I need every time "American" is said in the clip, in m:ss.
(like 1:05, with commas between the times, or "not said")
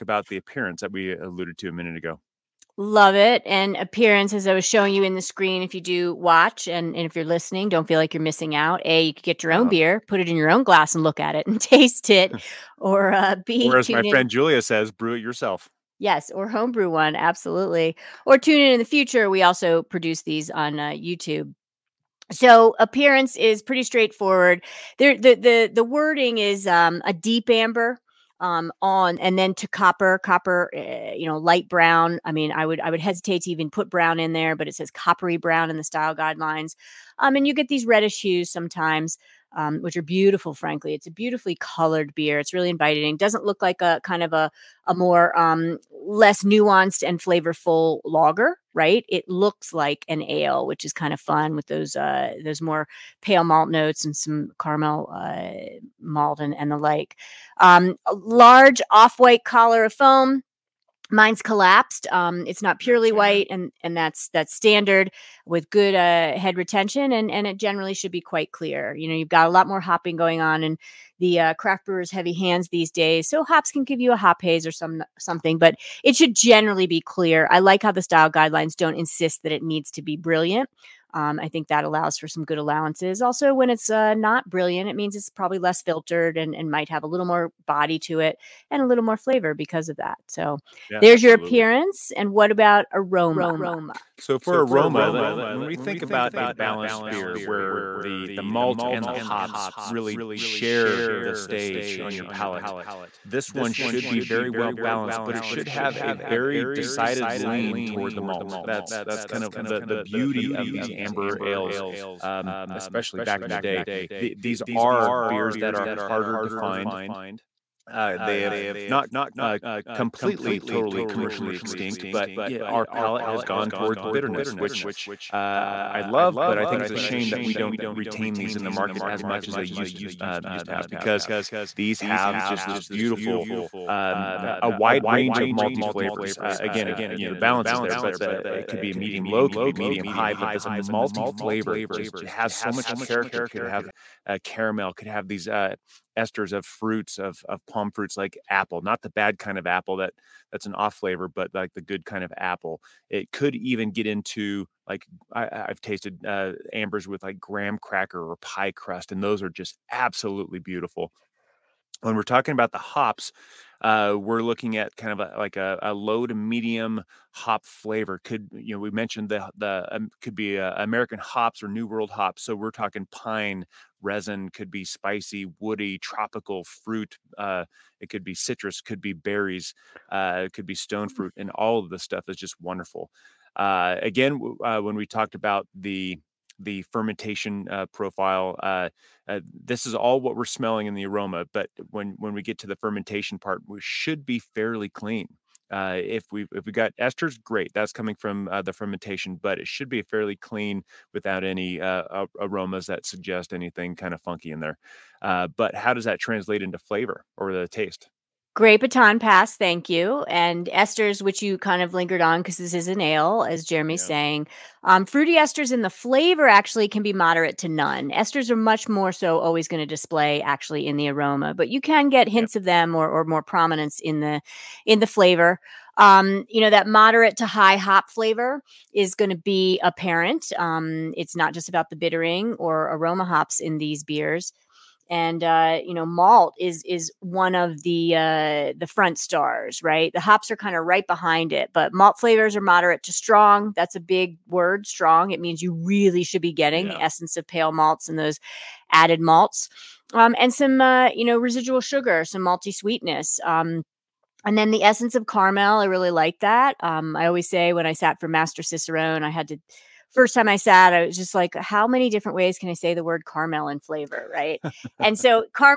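2:50.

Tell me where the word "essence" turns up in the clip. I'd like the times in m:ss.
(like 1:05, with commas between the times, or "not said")
4:07, 4:14.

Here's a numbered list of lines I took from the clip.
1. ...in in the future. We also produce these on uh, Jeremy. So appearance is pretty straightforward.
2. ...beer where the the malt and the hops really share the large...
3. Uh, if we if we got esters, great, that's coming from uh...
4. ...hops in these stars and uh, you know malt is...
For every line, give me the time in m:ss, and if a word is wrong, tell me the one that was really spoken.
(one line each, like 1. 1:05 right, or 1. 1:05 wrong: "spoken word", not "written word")
1. 0:18 wrong: "YouTube", not "Jeremy"
2. 1:37 wrong: "stage", not "large"
3. 3:15 right
4. 3:53 wrong: "beers", not "stars".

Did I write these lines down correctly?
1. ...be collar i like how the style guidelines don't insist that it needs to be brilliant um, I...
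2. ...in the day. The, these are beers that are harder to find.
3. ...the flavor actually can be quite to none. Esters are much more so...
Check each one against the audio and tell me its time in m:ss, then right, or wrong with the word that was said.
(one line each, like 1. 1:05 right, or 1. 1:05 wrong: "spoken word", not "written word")
1. 1:16 wrong: "clear", not "collar"
2. 1:53 right
3. 3:35 wrong: "moderate", not "quite".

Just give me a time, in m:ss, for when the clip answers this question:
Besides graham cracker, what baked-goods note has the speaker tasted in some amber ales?
2:38.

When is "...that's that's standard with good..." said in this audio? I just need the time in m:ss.
1:03.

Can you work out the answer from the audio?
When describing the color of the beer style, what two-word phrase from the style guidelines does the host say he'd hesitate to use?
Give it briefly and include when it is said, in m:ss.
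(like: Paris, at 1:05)
coppery brown, at 0:34.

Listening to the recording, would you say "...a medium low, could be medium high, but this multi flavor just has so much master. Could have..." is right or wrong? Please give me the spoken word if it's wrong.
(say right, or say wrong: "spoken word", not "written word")
wrong: "character", not "master".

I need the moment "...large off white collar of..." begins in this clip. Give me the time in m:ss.
0:58.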